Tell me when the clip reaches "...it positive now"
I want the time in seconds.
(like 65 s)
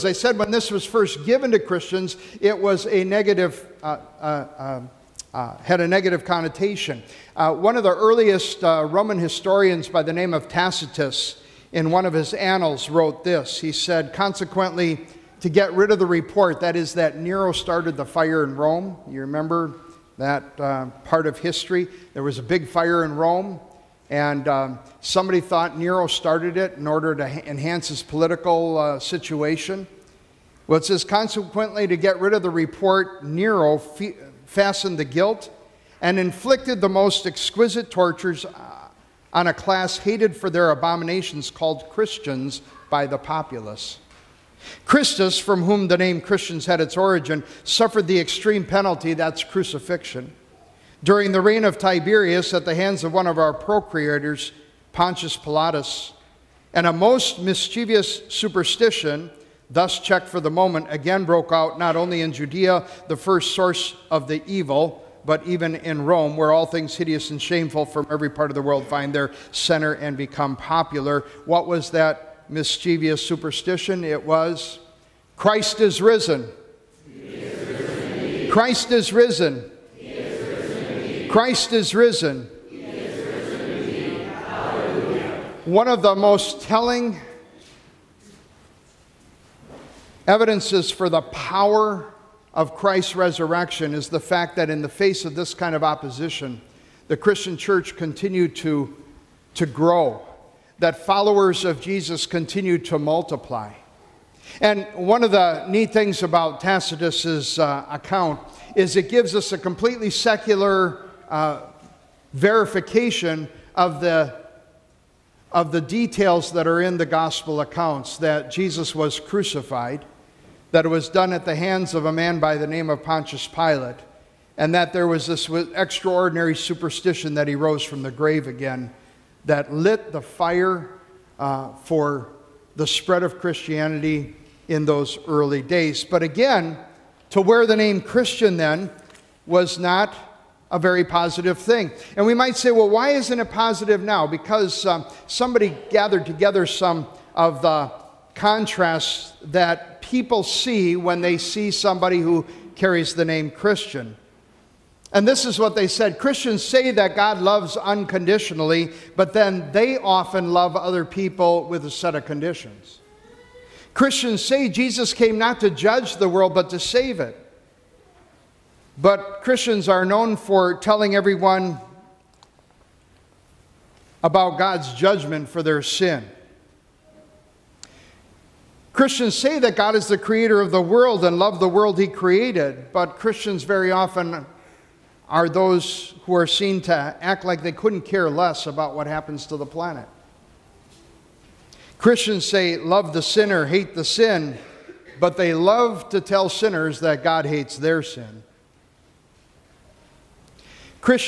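143 s.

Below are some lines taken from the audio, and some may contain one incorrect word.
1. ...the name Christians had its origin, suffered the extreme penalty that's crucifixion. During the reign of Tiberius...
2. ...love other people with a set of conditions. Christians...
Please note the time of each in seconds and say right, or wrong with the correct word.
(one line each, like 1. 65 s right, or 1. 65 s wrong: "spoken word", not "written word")
1. 45 s right
2. 160 s right.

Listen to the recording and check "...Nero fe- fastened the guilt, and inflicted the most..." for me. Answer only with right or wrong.
right.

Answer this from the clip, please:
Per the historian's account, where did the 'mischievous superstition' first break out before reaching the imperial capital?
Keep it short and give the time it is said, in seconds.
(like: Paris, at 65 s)
Judea, at 62 s.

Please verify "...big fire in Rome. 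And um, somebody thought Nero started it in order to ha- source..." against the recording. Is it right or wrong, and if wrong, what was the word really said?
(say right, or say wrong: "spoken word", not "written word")
wrong: "enhance", not "source".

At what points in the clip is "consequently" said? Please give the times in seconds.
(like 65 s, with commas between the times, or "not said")
14 s, 31 s.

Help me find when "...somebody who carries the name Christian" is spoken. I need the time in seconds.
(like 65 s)
151 s.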